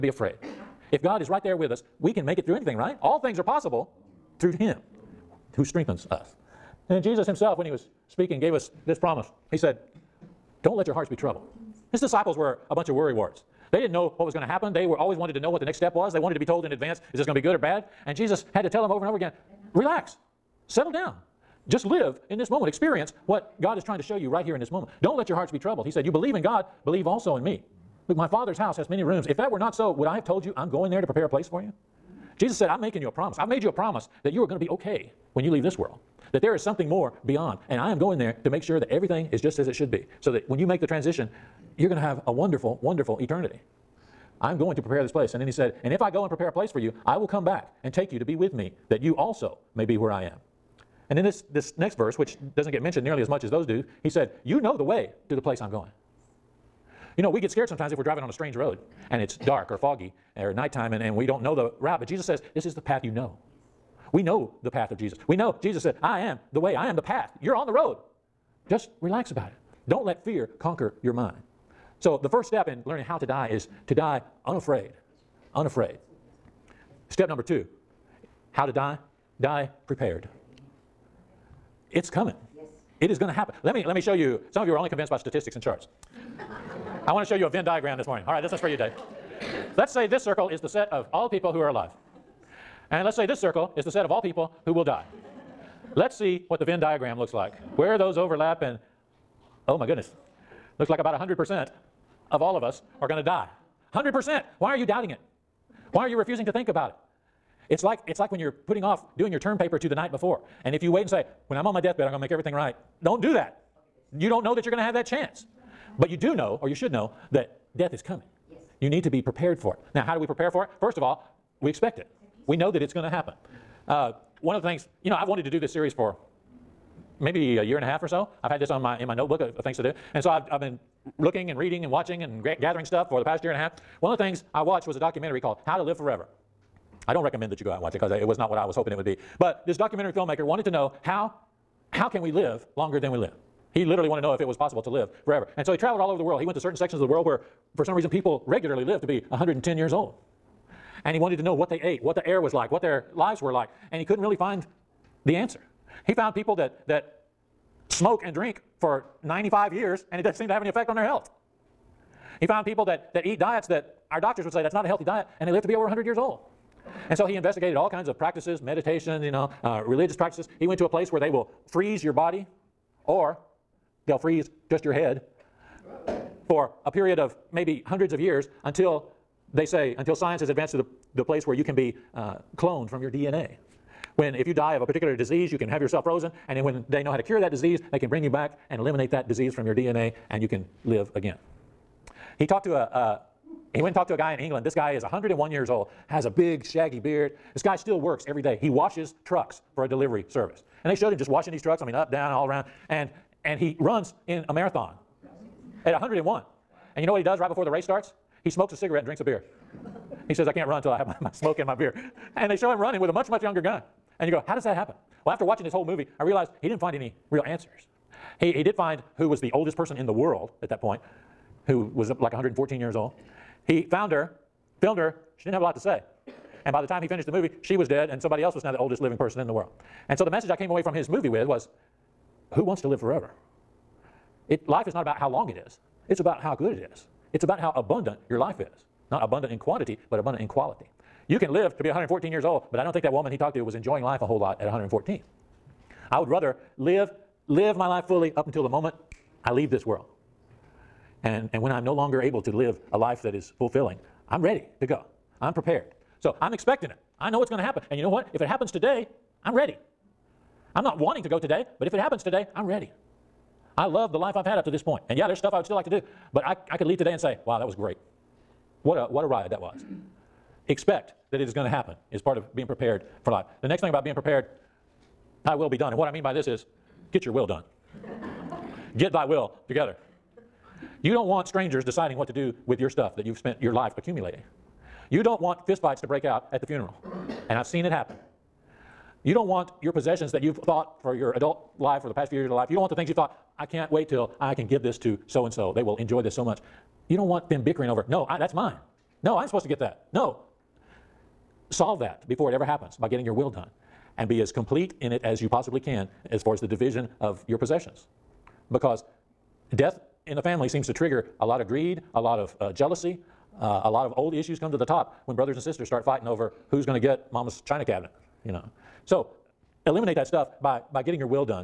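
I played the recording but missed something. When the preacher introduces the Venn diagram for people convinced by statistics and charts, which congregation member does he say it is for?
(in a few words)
Dave.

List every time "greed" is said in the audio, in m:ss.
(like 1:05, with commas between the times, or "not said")
5:11.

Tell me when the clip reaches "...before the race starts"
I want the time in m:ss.
3:27.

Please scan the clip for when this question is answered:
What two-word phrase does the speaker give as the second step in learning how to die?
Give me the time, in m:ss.
1:19.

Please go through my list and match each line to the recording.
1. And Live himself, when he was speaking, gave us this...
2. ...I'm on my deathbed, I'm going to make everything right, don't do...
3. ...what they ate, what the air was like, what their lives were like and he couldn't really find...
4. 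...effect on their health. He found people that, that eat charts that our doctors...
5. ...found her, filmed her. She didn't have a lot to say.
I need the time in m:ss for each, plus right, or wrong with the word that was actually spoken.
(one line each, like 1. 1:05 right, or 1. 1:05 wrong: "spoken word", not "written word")
1. 0:06 wrong: "Jesus", not "Live"
2. 1:51 right
3. 2:31 right
4. 2:40 wrong: "diets", not "charts"
5. 3:43 right.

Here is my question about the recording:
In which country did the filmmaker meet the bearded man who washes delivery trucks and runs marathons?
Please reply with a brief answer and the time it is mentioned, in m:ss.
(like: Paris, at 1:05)
England, at 3:14.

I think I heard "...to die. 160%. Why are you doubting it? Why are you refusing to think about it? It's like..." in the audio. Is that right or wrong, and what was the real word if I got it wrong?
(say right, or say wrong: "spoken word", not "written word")
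wrong: "100", not "160".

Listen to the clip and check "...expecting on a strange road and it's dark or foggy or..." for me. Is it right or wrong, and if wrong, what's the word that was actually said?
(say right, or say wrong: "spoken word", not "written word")
wrong: "driving", not "expecting".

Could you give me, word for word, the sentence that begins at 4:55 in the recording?
They will enjoy this so much.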